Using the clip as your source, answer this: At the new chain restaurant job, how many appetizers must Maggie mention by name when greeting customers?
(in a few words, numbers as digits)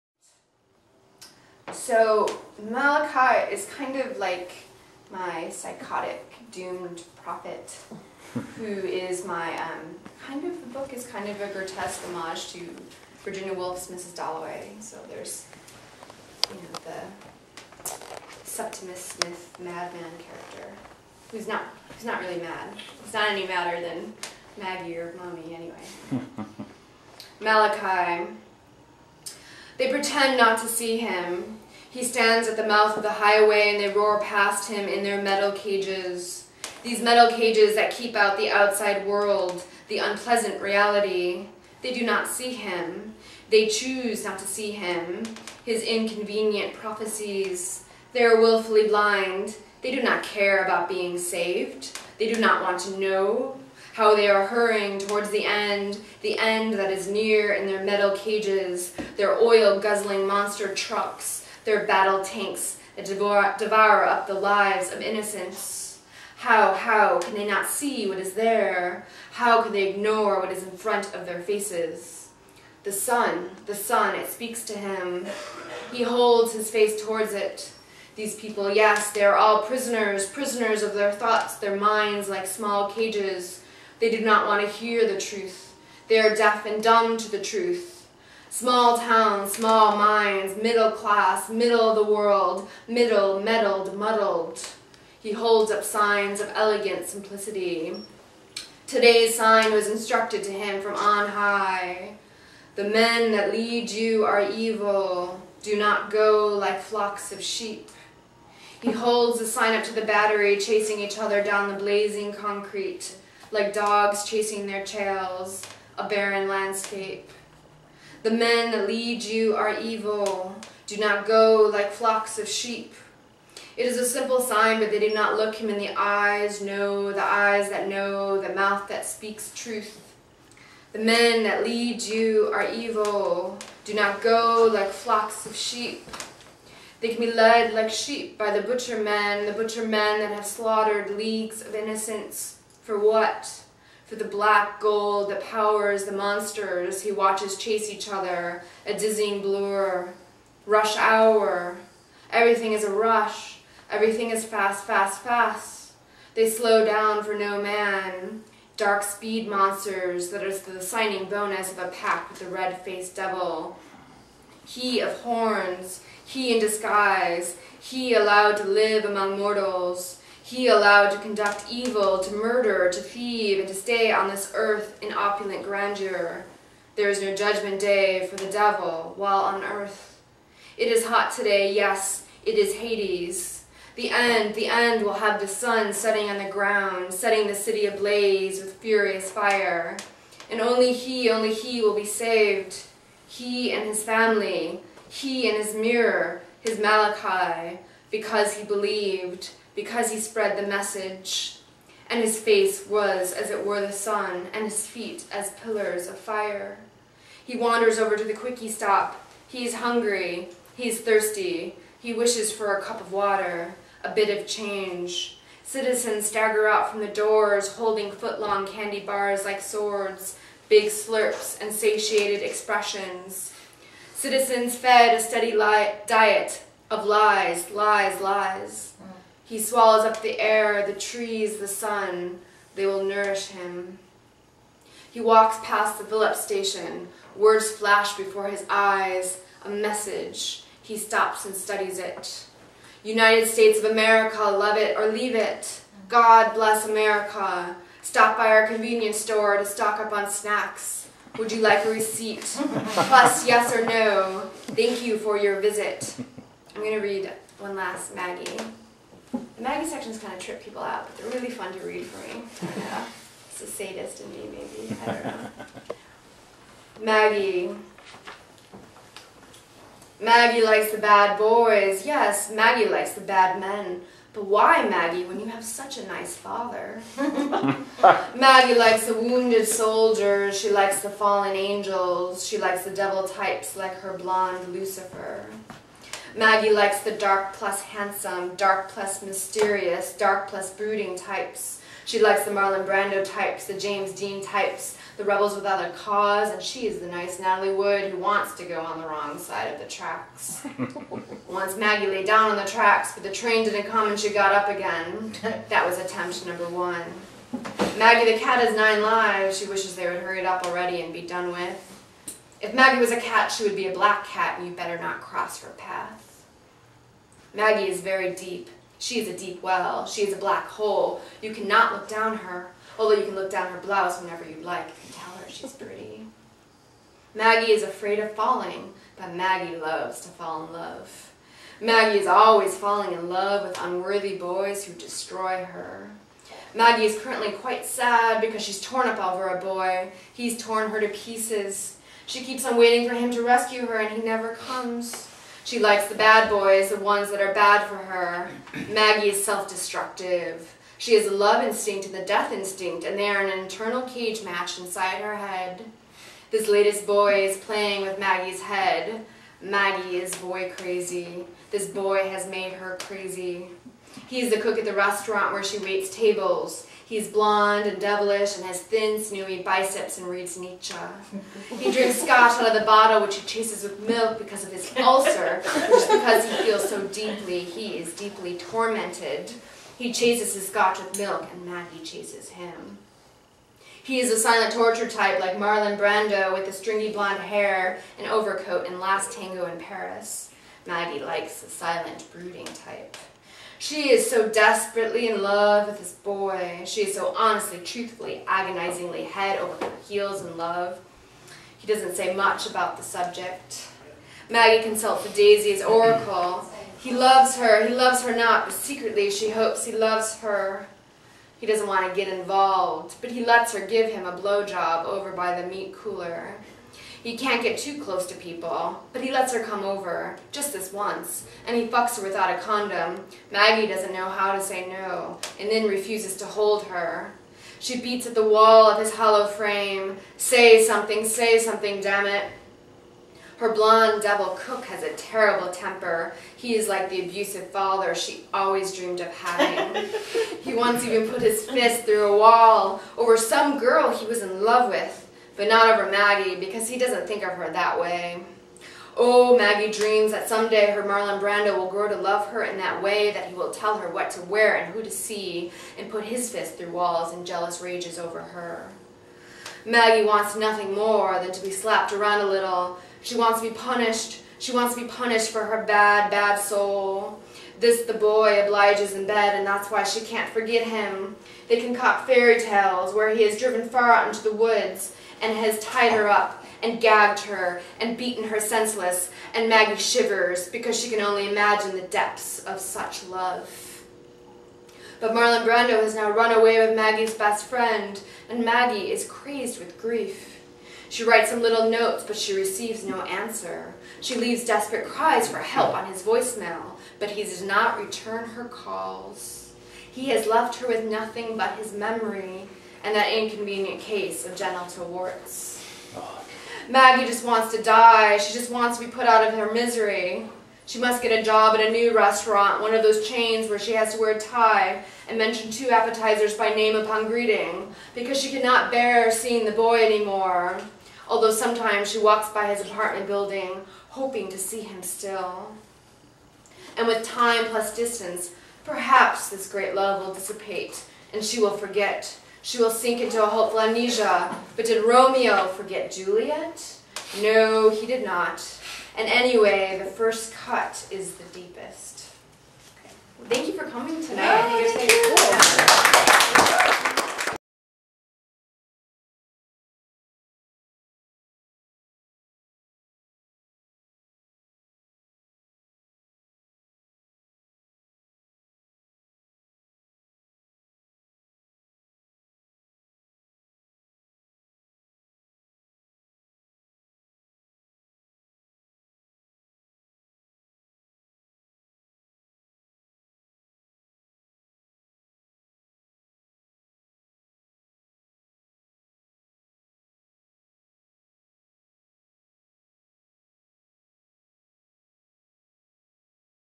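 2.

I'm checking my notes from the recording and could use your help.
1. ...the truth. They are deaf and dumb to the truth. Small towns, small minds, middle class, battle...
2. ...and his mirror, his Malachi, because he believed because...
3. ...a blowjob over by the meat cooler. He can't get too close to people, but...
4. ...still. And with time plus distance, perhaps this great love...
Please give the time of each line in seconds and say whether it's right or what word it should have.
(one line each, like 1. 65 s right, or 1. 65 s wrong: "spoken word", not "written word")
1. 85 s wrong: "middle", not "battle"
2. 195 s right
3. 414 s right
4. 525 s right.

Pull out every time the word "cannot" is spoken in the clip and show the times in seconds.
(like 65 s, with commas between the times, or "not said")
321 s, 518 s.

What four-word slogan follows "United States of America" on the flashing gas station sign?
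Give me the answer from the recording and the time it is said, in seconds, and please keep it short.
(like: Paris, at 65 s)
love it or leave it, at 244 s.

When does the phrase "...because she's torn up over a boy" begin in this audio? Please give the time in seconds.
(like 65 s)
338 s.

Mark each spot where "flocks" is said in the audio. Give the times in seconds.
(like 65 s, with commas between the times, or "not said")
106 s, 121 s, 134 s.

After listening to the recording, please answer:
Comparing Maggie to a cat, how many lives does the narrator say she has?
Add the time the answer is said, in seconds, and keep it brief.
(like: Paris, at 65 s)
9, at 308 s.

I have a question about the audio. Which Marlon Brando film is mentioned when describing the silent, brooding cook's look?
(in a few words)
Last Tango in Paris.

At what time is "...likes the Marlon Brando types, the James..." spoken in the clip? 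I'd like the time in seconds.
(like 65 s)
292 s.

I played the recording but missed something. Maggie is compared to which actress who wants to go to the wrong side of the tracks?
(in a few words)
Natalie Wood.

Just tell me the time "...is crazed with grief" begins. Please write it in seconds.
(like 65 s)
489 s.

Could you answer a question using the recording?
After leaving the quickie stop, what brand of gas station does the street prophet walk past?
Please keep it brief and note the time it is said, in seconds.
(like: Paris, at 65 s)
Phillips, at 236 s.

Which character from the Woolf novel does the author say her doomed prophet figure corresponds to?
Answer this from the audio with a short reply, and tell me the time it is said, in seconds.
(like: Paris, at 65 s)
Septimus Smith, at 18 s.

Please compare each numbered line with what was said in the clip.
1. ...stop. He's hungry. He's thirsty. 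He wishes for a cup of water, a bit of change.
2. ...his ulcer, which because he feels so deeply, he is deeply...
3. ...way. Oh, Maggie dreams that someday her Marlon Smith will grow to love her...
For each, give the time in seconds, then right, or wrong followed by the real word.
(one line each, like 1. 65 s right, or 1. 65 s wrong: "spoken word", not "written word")
1. 208 s right
2. 374 s right
3. 447 s wrong: "Brando", not "Smith".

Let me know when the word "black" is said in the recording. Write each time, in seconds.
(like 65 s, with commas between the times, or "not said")
144 s, 313 s, 320 s.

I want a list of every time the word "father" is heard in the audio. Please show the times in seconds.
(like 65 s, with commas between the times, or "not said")
276 s, 437 s.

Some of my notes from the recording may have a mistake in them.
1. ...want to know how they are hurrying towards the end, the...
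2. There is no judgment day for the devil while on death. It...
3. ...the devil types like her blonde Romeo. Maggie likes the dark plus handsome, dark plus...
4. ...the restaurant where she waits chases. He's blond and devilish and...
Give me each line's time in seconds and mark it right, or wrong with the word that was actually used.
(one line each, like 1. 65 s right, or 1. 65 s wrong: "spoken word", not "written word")
1. 52 s right
2. 176 s wrong: "earth", not "death"
3. 282 s wrong: "Lucifer", not "Romeo"
4. 364 s wrong: "tables", not "chases".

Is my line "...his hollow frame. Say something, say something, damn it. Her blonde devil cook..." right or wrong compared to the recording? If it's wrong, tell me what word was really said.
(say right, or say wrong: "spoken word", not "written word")
right.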